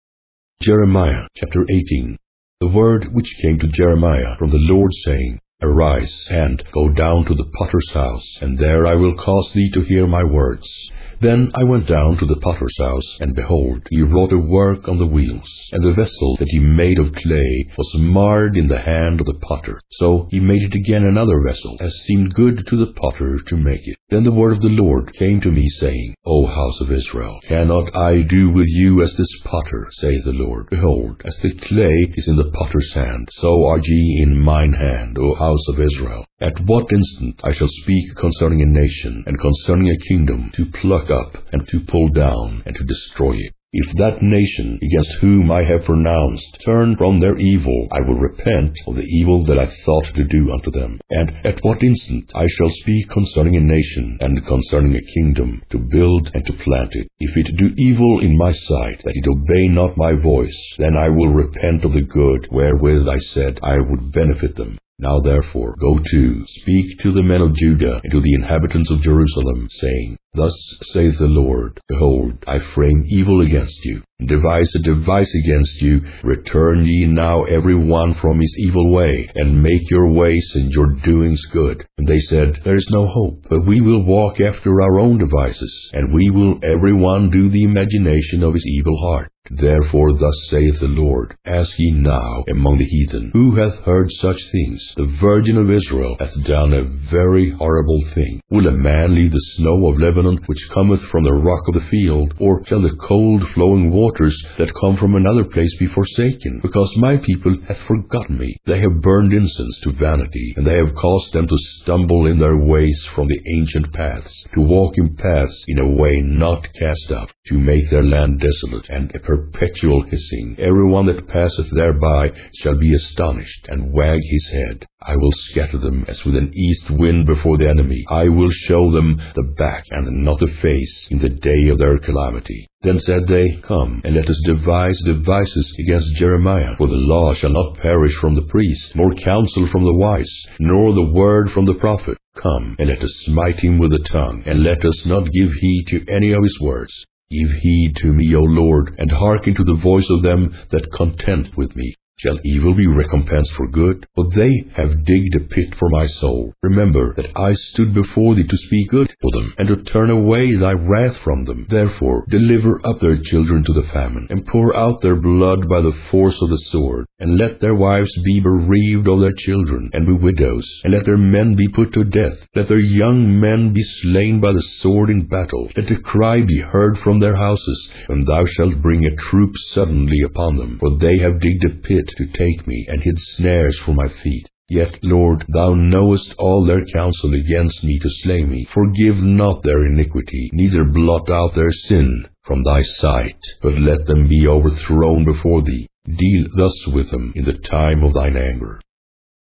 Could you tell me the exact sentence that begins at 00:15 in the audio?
And the vessel that he made of clay was marred in the hand of the potter.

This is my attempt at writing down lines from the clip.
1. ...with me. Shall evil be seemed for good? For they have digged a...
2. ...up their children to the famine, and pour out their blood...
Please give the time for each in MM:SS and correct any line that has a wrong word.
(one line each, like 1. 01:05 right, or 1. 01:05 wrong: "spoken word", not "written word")
1. 02:31 wrong: "recompensed", not "seemed"
2. 02:42 right.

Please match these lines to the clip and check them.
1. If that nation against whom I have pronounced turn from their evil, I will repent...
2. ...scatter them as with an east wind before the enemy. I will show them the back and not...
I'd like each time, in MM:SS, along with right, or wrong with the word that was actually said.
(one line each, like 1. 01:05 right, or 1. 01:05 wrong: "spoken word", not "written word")
1. 00:43 right
2. 02:05 right.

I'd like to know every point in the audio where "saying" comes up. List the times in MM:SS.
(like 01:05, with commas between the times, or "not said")
00:05, 00:25, 01:09.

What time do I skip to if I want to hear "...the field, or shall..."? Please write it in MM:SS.
01:41.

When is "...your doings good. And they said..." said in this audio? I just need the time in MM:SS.
01:20.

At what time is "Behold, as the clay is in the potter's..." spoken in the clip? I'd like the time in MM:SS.
00:30.